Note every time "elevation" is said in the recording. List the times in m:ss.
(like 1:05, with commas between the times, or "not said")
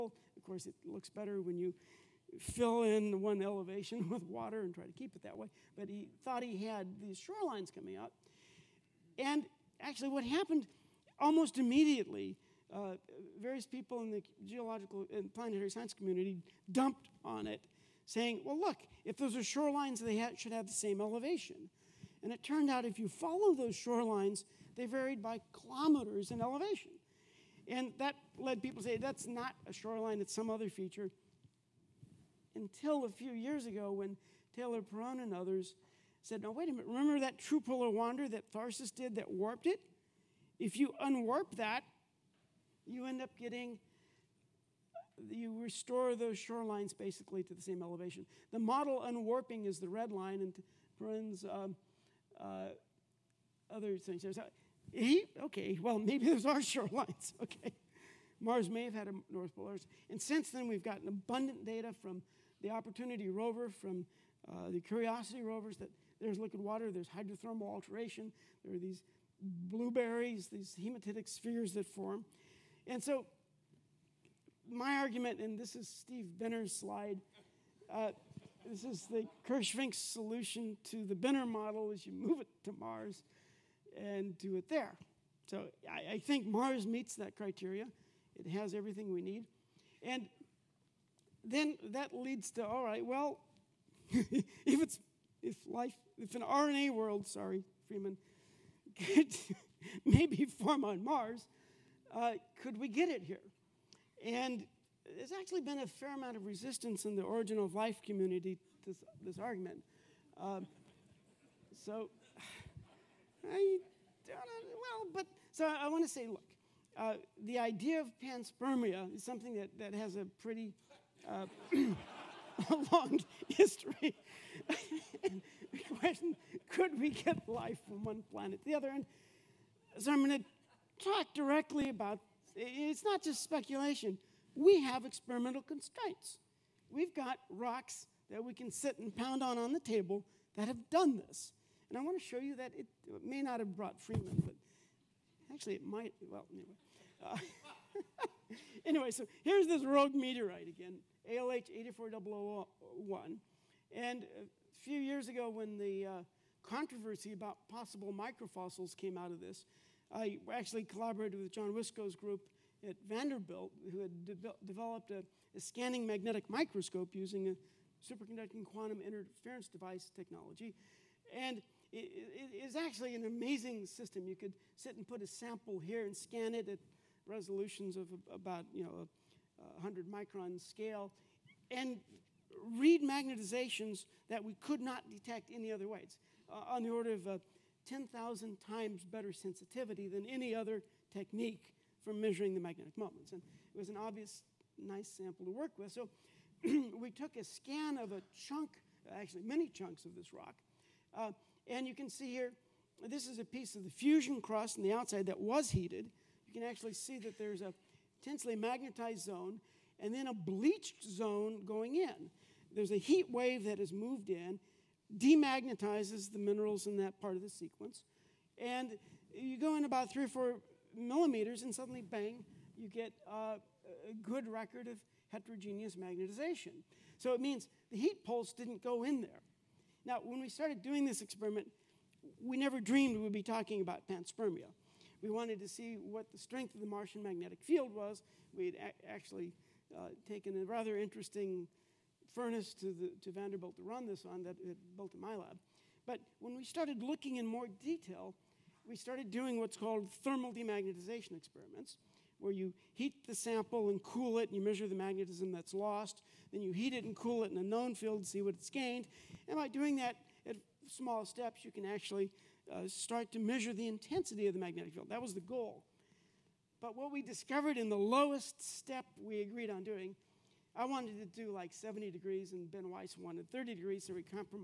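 0:03, 0:21, 0:26, 0:47.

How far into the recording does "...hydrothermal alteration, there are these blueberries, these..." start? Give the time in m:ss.
1:07.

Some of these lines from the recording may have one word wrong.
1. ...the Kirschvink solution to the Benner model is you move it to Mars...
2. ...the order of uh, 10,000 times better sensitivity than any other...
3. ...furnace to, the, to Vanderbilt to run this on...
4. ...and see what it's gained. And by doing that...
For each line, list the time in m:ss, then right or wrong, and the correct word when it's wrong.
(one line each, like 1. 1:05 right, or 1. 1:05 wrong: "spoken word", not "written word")
1. 1:19 right
2. 3:06 right
3. 4:02 right
4. 4:18 right.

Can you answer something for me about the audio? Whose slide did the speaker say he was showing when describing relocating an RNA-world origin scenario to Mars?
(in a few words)
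Steve Benner.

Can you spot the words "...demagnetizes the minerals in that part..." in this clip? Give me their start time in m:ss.
3:35.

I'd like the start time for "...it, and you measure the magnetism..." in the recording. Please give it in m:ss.
4:14.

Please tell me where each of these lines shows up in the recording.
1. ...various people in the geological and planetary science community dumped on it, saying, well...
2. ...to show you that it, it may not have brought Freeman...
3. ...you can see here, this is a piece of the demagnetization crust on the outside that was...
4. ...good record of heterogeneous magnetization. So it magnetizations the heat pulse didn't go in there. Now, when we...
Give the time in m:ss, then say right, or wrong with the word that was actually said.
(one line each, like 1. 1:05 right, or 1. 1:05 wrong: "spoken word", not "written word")
1. 0:13 right
2. 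2:22 right
3. 3:21 wrong: "fusion", not "demagnetization"
4. 3:44 wrong: "means", not "magnetizations".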